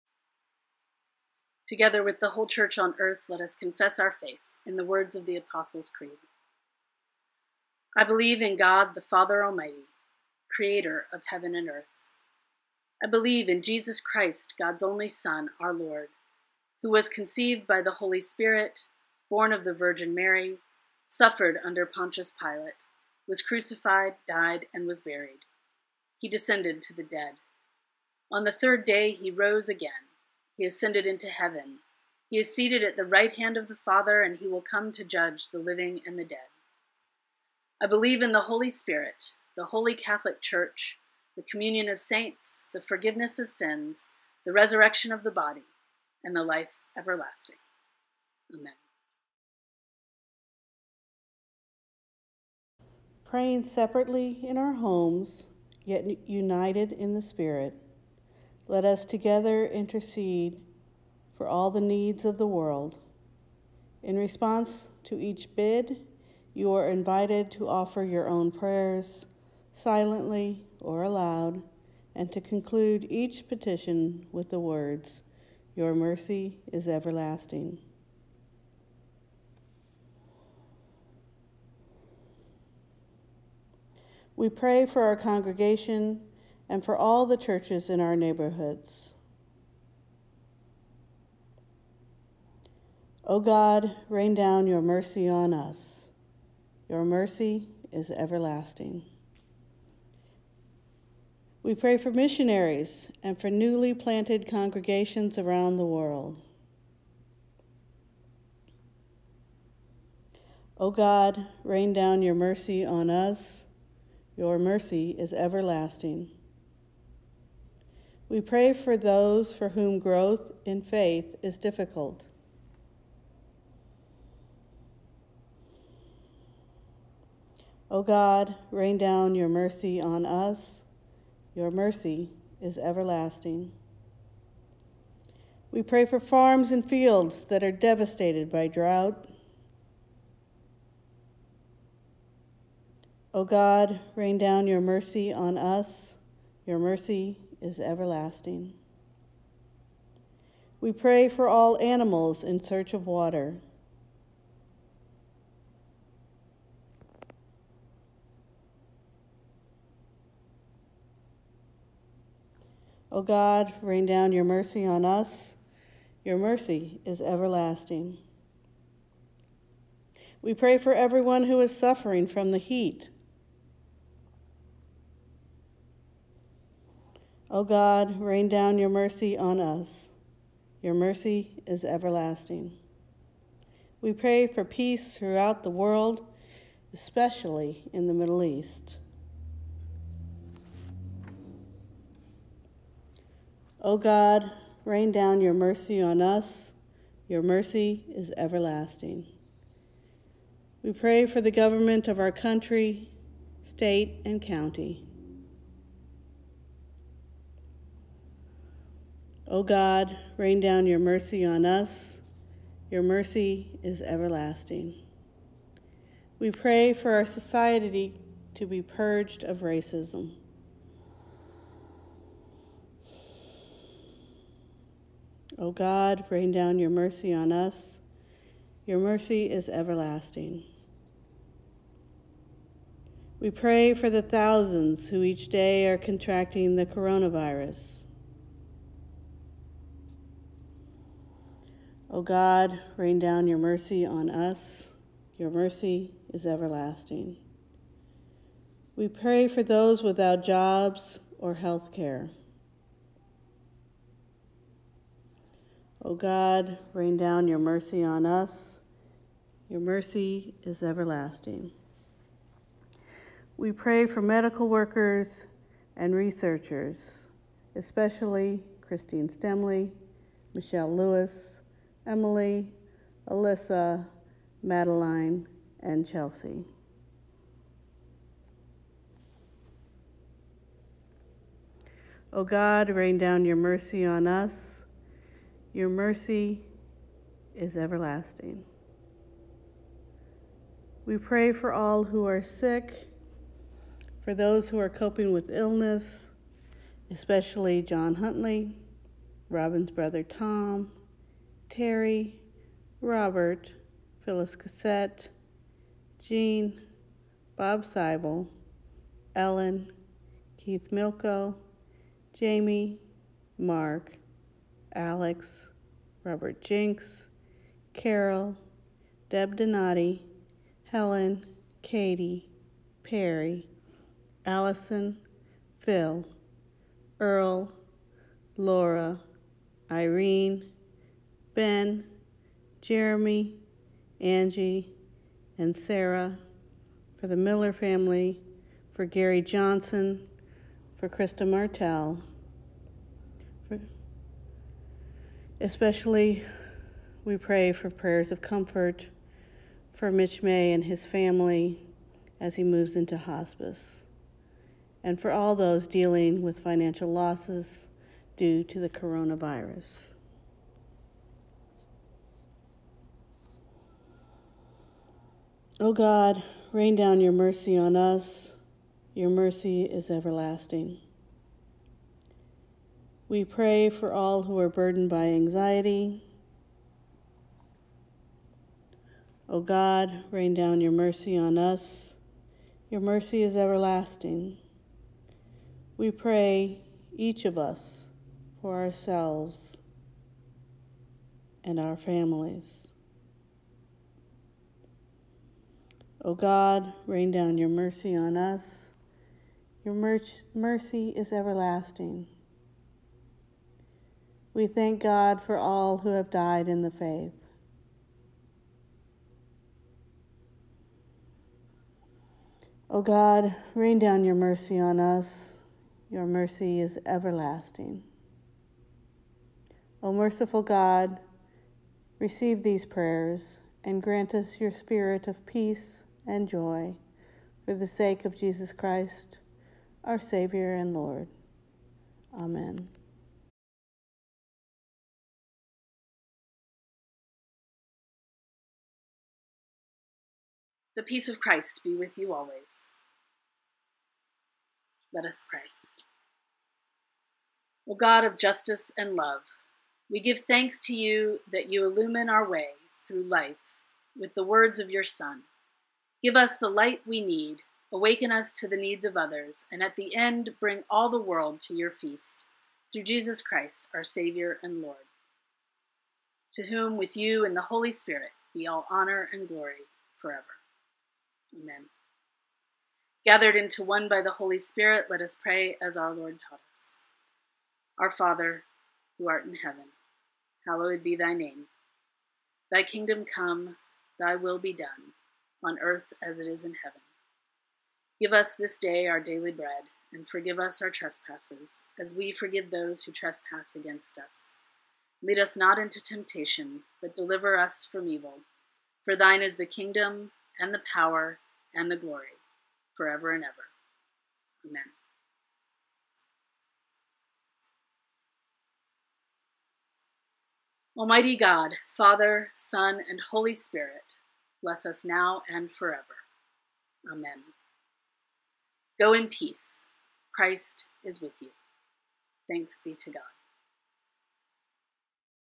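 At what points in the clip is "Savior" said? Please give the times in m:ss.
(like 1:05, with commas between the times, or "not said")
7:10, 7:44.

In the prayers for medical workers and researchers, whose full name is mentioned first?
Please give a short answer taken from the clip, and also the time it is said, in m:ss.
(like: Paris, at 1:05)
Christine Stemley, at 4:28.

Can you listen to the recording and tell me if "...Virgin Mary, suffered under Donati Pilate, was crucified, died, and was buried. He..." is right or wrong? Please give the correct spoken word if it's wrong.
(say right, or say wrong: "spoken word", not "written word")
wrong: "Pontius", not "Donati".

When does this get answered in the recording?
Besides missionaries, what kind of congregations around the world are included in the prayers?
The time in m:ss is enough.
1:43.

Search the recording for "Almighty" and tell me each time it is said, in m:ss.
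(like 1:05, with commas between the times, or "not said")
0:09, 8:30.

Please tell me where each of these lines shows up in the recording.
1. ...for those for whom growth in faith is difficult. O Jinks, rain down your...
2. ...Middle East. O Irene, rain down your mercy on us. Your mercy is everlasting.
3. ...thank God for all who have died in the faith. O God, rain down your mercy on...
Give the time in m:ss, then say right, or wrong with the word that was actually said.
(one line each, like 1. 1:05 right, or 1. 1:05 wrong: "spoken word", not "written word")
1. 1:58 wrong: "God", not "Jinks"
2. 3:08 wrong: "God", not "Irene"
3. 6:44 right.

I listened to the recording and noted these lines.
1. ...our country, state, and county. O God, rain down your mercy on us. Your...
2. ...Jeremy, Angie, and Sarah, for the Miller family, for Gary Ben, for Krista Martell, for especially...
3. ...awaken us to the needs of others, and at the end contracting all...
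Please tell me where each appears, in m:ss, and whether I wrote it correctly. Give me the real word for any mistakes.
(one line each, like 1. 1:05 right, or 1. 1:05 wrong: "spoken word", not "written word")
1. 3:22 right
2. 5:32 wrong: "Johnson", not "Ben"
3. 7:37 wrong: "bring", not "contracting".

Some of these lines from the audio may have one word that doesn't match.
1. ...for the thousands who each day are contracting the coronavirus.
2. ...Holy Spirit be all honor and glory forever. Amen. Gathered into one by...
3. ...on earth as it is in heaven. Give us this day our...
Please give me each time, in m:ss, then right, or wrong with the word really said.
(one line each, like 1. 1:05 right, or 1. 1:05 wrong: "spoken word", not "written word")
1. 3:53 right
2. 7:47 right
3. 8:05 right.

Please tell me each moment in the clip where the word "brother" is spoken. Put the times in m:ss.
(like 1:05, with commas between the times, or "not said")
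4:59.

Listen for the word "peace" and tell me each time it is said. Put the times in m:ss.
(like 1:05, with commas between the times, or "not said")
3:04, 7:05, 7:21, 8:39.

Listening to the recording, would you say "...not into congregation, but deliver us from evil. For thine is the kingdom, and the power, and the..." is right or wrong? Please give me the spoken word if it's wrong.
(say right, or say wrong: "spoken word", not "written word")
wrong: "temptation", not "congregation".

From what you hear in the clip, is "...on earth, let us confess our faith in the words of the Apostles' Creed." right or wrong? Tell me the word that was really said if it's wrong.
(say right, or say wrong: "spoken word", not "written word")
right.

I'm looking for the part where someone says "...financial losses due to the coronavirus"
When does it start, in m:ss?
5:56.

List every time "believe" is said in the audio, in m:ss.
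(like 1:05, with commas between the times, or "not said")
0:08, 0:13, 0:37.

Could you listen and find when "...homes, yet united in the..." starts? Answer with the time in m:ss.
0:54.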